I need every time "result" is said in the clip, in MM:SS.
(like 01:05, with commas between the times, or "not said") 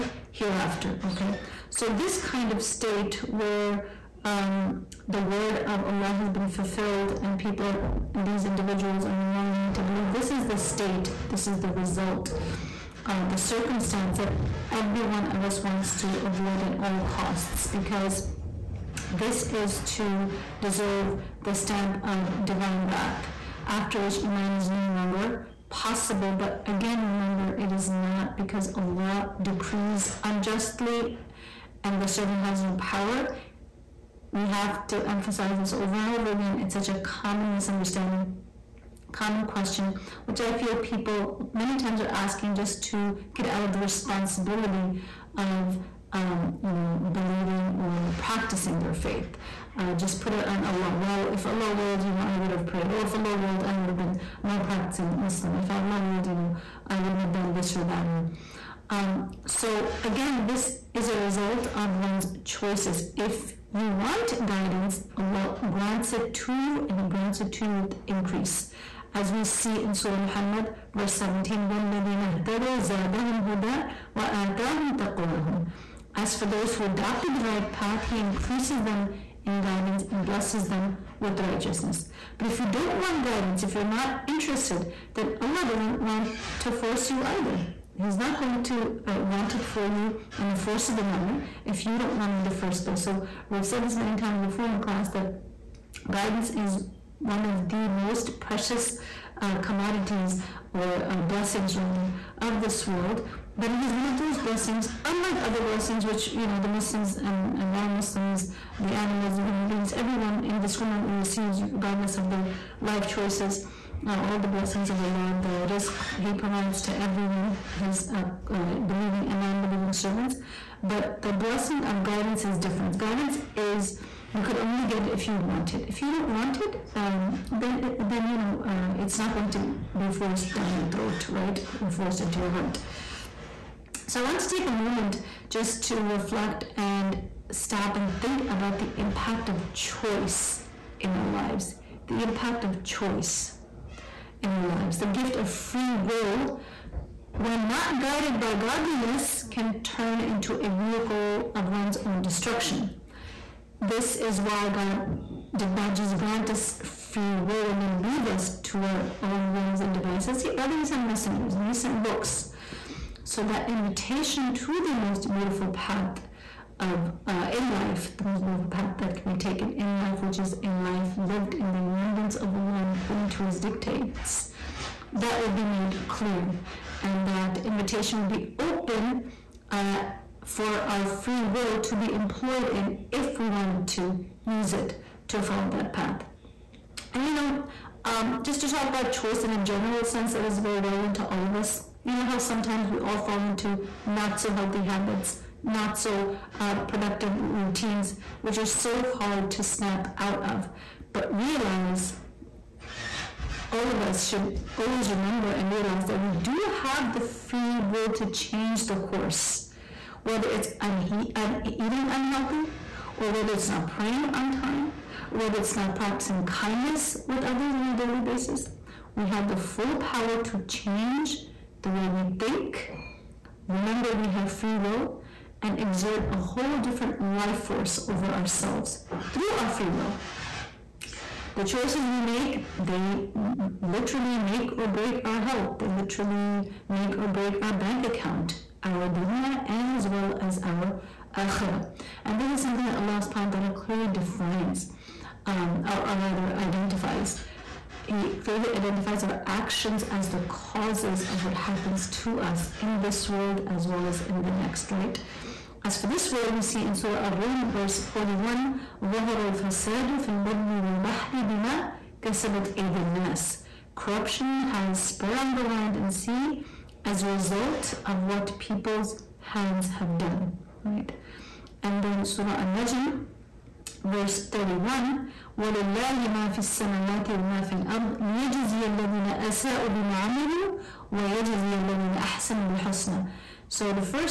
00:11, 01:01, 04:27.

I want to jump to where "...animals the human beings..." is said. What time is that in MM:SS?
01:48.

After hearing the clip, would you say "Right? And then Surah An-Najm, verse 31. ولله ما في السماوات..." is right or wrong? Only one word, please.
right.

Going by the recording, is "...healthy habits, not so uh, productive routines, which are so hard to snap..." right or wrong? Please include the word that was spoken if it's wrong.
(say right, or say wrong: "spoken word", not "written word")
right.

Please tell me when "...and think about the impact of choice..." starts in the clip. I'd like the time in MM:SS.
02:17.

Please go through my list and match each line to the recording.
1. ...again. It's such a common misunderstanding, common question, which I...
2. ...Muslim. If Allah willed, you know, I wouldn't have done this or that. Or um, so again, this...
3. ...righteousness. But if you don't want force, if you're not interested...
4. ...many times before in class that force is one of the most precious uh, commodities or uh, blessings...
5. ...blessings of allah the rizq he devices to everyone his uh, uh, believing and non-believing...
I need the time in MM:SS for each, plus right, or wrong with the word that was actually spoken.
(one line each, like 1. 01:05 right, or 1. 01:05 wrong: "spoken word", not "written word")
1. 00:36 right
2. 00:55 right
3. 01:21 wrong: "guidance", not "force"
4. 01:33 wrong: "guidance", not "force"
5. 01:54 wrong: "provides", not "devices".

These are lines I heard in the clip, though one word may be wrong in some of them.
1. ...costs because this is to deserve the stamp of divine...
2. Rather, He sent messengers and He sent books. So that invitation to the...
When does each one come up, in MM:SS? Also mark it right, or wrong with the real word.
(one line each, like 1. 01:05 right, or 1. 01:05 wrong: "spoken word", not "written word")
1. 00:16 right
2. 02:40 right.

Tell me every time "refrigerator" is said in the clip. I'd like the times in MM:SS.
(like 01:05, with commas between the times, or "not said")
not said.